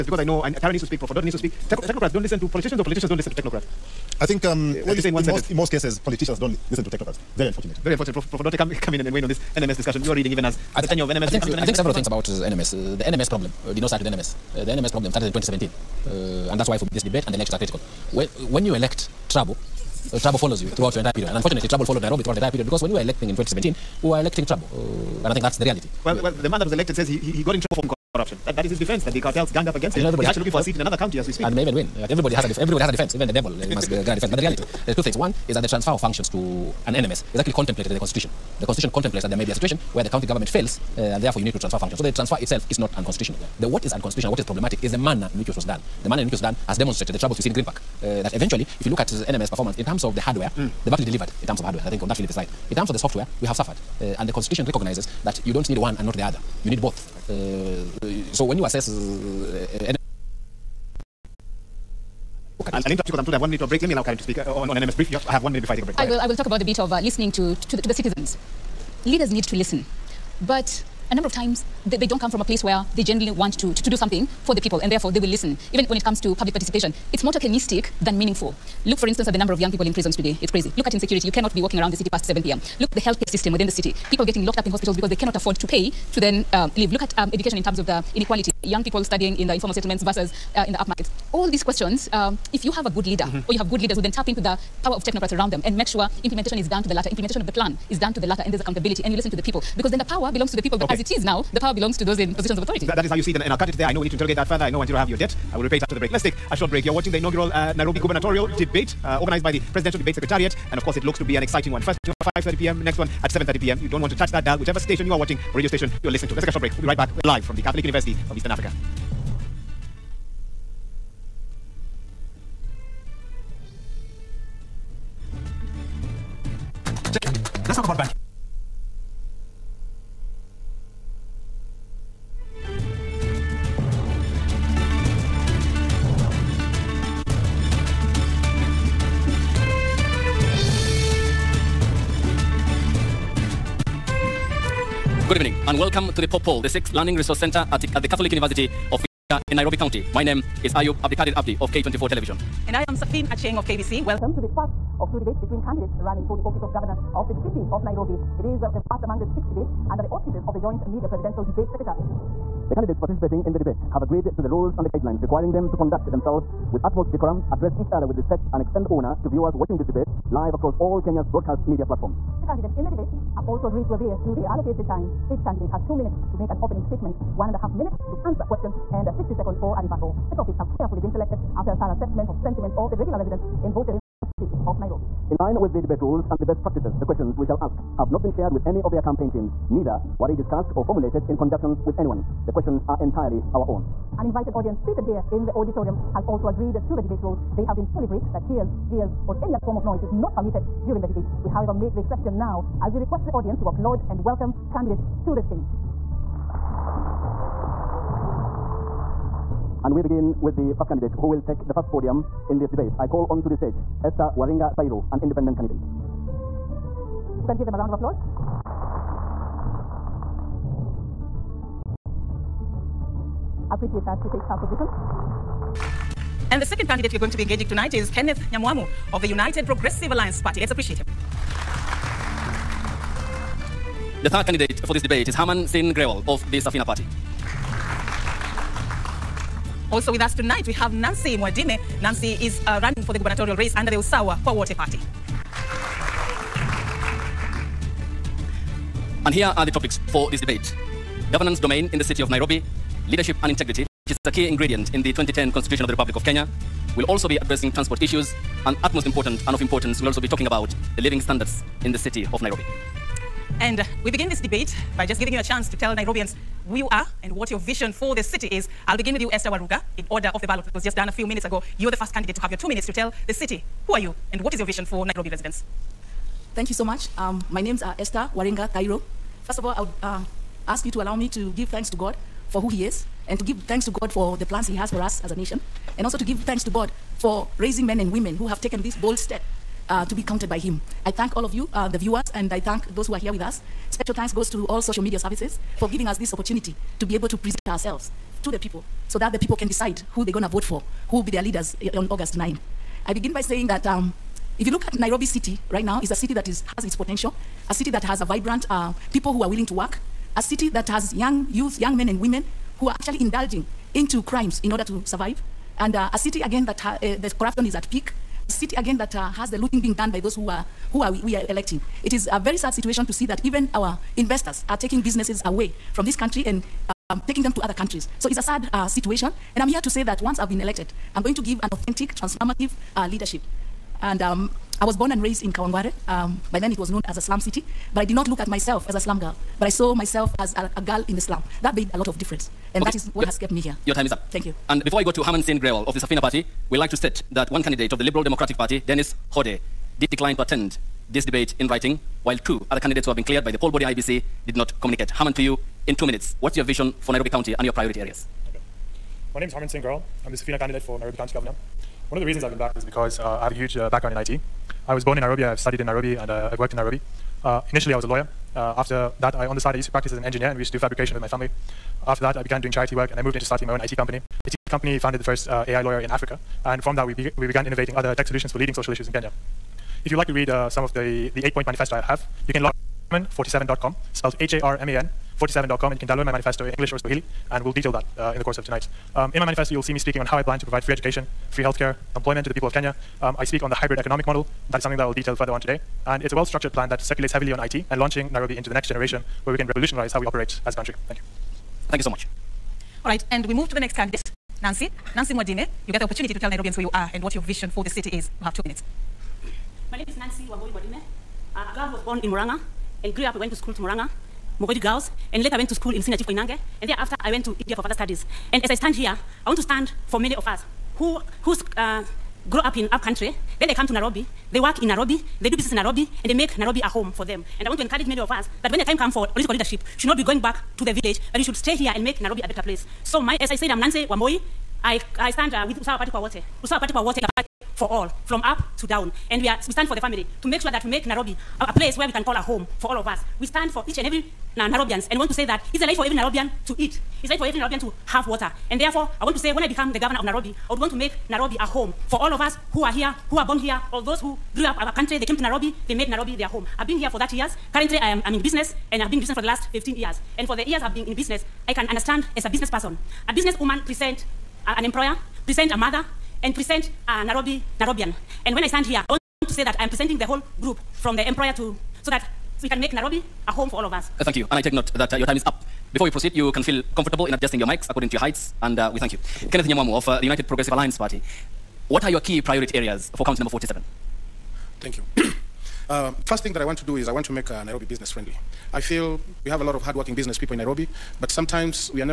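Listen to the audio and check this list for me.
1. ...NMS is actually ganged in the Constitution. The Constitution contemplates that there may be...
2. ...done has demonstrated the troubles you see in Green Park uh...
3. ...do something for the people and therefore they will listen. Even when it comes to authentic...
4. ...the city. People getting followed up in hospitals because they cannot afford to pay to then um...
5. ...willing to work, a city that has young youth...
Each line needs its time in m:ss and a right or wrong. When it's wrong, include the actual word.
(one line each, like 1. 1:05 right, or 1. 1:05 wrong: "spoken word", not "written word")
1. 0:36 wrong: "contemplated", not "ganged"
2. 0:46 right
3. 1:13 wrong: "public", not "authentic"
4. 1:23 wrong: "locked", not "followed"
5. 5:09 right.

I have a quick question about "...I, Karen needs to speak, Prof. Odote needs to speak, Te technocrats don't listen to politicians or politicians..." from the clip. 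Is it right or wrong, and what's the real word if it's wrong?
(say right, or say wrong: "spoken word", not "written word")
right.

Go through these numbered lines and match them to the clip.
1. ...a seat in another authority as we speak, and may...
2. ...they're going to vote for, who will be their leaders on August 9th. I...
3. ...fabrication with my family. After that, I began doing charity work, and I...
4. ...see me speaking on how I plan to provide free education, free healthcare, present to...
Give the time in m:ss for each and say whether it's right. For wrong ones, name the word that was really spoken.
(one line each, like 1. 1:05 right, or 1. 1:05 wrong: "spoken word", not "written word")
1. 0:30 wrong: "county", not "authority"
2. 5:00 right
3. 6:10 right
4. 6:29 wrong: "employment", not "present".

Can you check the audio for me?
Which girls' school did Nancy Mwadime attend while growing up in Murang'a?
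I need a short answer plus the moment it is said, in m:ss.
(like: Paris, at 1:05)
Mugoiri Girls, at 6:54.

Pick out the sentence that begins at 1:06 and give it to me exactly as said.
I will talk about the bit of uh, listening to to the, to the citizens.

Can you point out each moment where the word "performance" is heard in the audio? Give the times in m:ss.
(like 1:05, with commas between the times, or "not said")
0:49.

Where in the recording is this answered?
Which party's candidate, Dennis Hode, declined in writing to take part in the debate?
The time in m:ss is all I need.
5:48.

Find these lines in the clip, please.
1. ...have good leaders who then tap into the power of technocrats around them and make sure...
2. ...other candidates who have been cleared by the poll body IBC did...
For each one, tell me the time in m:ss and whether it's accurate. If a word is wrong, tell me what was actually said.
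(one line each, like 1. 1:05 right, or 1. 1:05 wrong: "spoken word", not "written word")
1. 1:33 right
2. 5:52 right.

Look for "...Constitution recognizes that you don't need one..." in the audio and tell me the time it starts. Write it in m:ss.
0:54.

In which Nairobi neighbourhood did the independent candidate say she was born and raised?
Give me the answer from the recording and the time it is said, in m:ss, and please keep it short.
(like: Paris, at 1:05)
Kawangware, at 5:35.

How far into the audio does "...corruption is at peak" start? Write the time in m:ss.
5:17.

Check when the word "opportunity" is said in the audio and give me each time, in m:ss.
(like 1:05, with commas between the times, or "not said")
4:56, 6:46.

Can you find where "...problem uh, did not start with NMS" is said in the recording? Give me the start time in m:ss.
0:13.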